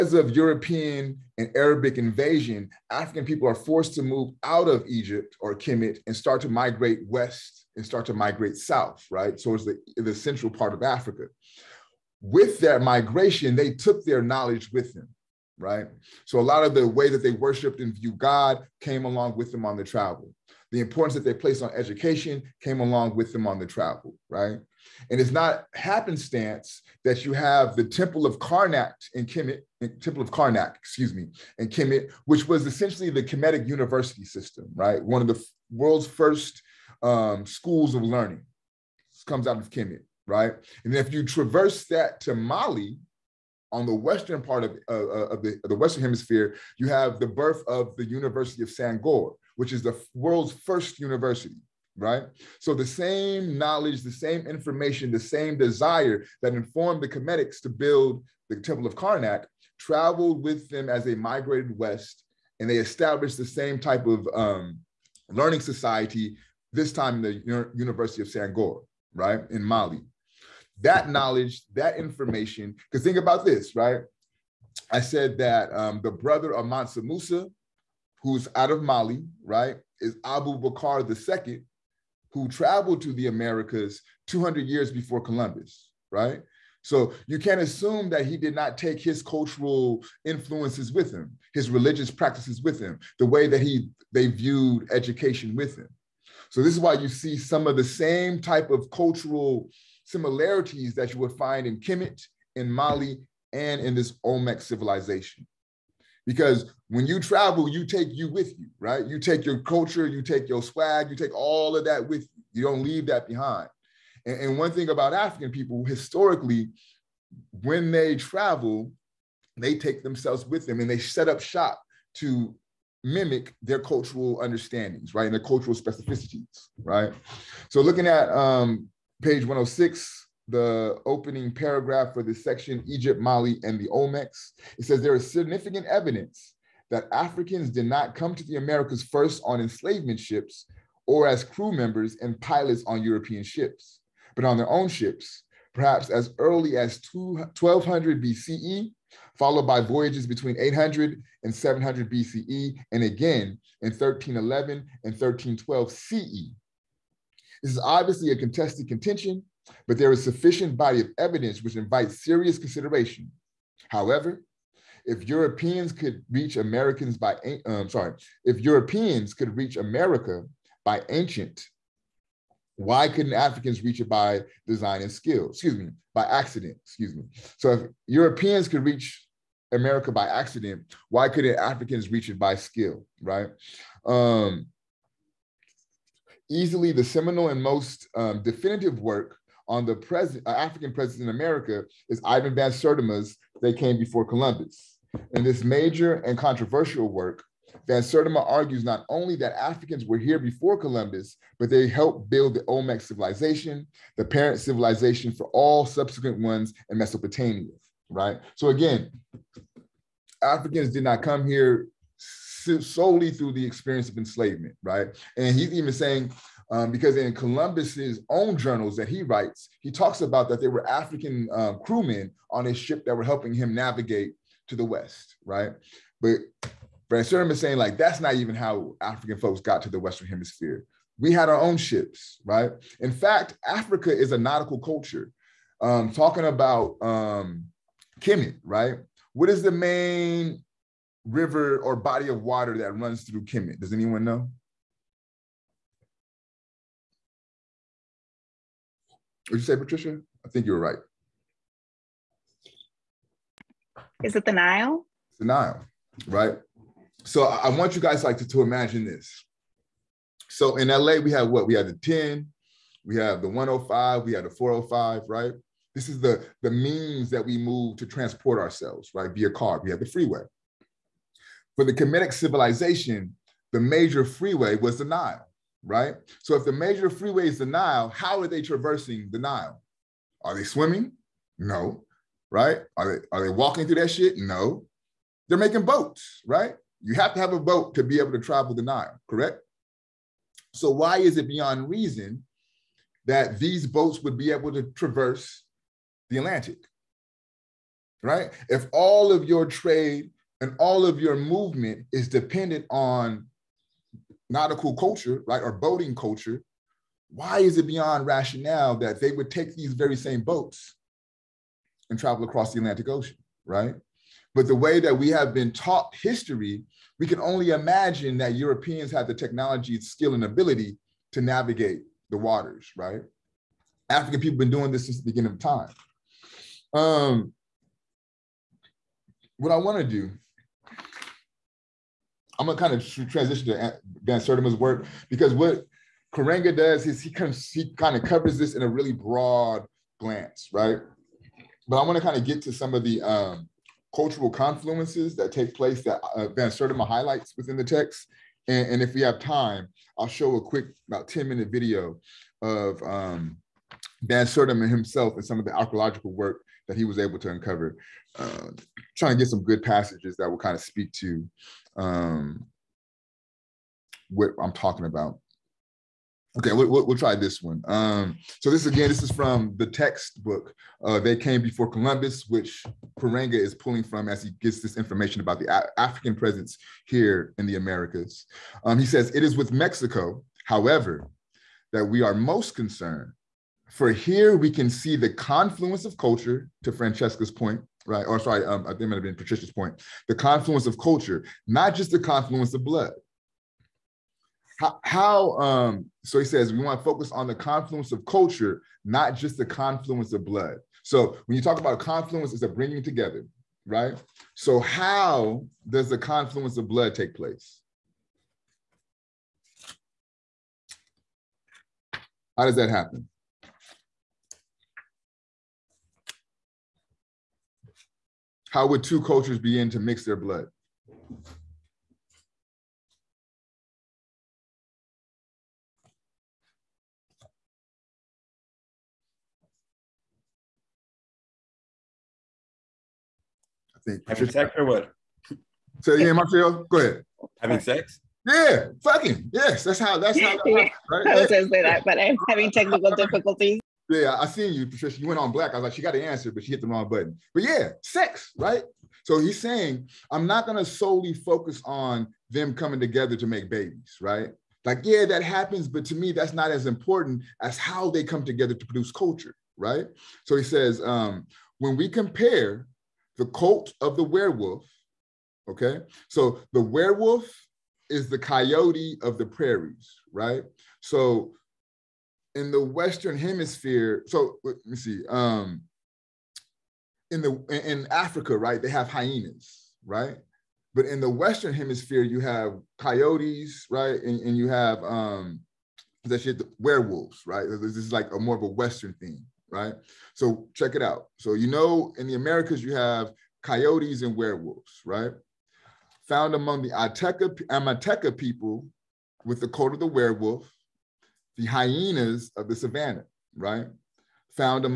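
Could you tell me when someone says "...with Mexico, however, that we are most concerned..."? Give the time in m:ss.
6:19.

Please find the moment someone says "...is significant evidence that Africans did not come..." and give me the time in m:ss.
2:15.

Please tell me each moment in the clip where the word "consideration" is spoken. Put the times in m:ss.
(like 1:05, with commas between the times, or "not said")
2:42.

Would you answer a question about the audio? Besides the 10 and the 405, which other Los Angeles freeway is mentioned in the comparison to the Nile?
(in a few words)
105.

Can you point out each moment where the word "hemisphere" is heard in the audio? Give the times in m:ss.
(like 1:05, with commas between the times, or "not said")
0:46, 3:50, 7:53, 8:01.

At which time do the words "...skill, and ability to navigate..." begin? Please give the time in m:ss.
5:19.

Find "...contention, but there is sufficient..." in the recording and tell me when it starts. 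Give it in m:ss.
2:38.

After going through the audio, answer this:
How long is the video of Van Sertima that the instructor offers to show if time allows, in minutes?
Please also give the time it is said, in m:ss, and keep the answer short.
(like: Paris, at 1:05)
10 minutes, at 5:51.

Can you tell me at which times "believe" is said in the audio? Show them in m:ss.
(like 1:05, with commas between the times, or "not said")
not said.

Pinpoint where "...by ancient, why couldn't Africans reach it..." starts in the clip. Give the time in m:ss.
2:50.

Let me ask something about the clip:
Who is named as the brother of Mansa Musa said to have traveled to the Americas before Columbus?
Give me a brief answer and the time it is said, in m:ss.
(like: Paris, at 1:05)
Abu Bakr II, at 1:20.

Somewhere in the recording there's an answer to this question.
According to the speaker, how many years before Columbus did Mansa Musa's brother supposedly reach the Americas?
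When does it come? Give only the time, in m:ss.
1:24.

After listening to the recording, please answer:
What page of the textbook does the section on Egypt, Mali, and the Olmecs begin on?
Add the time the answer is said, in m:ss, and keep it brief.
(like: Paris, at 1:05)
106, at 2:09.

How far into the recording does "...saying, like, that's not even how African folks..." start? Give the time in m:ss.
3:47.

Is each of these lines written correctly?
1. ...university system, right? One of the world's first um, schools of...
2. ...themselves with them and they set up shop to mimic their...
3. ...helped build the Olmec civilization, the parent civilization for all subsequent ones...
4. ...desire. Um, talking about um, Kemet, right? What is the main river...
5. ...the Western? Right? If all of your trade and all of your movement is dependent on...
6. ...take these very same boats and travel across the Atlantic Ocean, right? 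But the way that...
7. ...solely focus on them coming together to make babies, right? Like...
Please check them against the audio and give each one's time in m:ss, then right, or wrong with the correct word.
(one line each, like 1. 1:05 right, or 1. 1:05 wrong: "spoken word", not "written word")
1. 0:33 right
2. 2:00 right
3. 3:21 right
4. 3:54 wrong: "culture", not "desire"
5. 4:56 wrong: "Atlantic", not "Western"
6. 5:09 right
7. 7:30 right.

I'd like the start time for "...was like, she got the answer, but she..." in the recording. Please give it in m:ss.
7:25.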